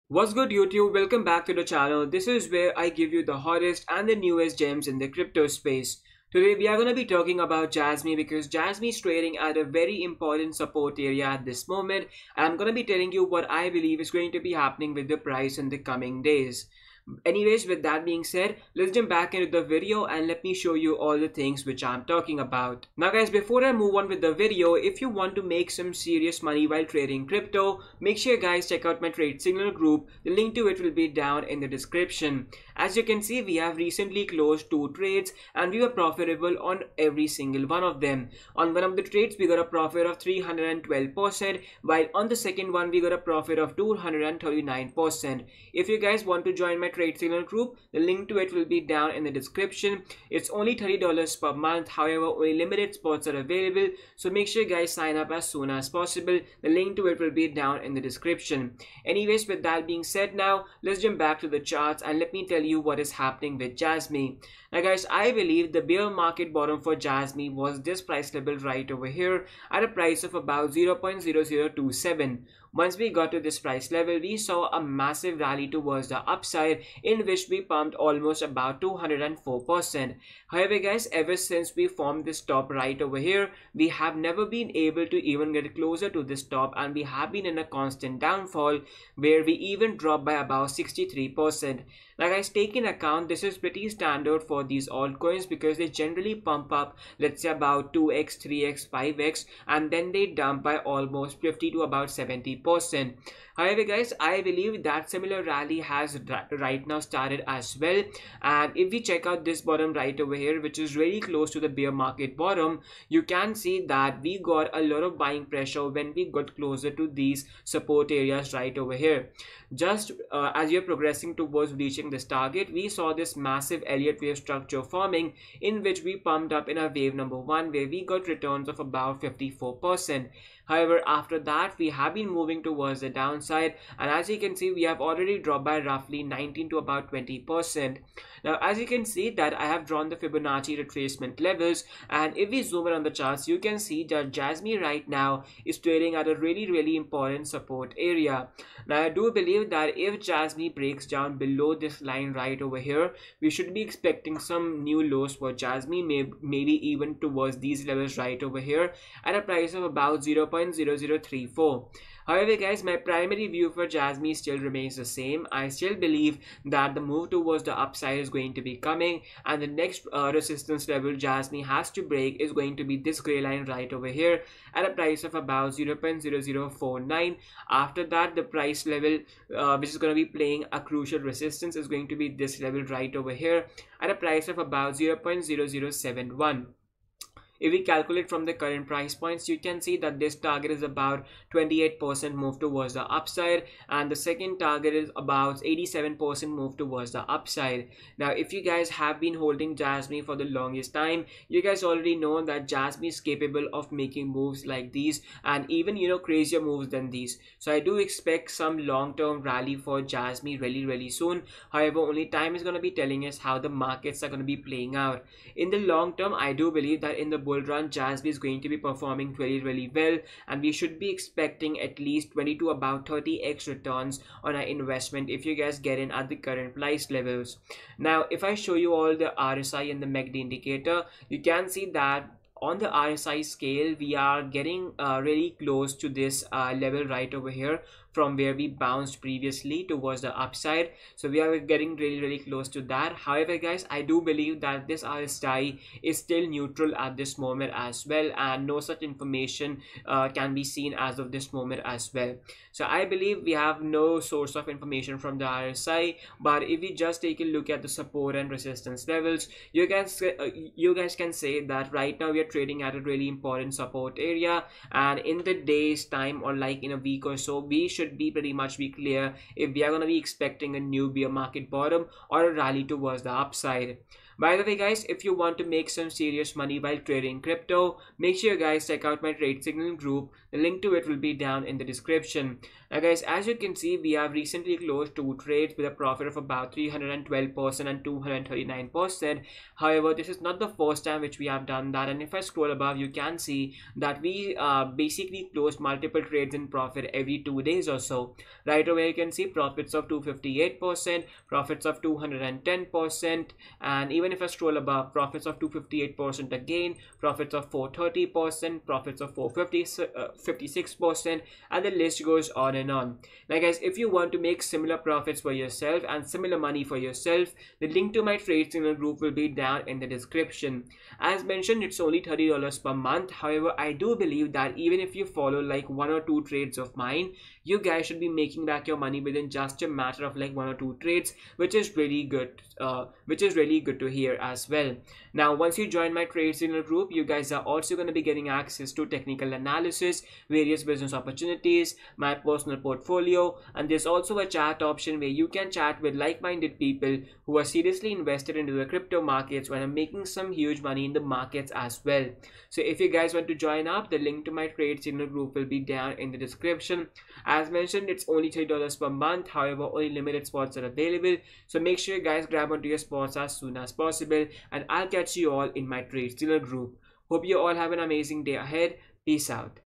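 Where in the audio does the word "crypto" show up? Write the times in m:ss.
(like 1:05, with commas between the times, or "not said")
0:05, 0:27, 4:37, 5:48.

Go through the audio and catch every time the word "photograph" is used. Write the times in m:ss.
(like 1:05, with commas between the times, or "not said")
not said.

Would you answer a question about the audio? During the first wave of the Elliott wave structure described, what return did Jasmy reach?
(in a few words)
54%.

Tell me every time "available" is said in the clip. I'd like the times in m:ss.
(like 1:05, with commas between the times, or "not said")
0:53, 6:00.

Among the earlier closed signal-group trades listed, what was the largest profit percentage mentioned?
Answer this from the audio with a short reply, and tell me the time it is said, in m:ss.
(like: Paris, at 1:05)
456%, at 5:09.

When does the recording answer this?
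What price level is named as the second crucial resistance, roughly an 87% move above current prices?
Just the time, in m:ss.
3:04.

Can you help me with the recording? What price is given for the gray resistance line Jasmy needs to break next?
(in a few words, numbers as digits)
0.0049.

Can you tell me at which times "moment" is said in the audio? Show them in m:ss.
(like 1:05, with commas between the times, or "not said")
0:11, 4:07, 4:11.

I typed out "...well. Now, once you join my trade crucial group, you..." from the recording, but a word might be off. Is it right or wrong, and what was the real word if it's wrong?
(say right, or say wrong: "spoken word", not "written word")
wrong: "signal", not "crucial".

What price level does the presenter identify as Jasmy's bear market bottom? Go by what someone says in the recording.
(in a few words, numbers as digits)
0.0027.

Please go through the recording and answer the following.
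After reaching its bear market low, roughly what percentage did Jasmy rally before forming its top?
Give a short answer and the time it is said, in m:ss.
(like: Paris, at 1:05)
204%, at 1:18.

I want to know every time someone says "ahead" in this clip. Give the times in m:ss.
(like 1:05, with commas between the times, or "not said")
6:08.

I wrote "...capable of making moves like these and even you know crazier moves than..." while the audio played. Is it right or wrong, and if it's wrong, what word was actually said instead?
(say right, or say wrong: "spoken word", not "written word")
right.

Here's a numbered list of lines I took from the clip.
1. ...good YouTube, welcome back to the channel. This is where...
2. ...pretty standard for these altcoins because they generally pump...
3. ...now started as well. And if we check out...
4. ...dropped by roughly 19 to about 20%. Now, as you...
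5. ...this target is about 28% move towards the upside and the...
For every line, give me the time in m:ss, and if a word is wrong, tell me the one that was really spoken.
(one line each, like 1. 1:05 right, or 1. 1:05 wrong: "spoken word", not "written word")
1. 0:00 right
2. 1:33 right
3. 1:46 right
4. 2:15 right
5. 3:10 right.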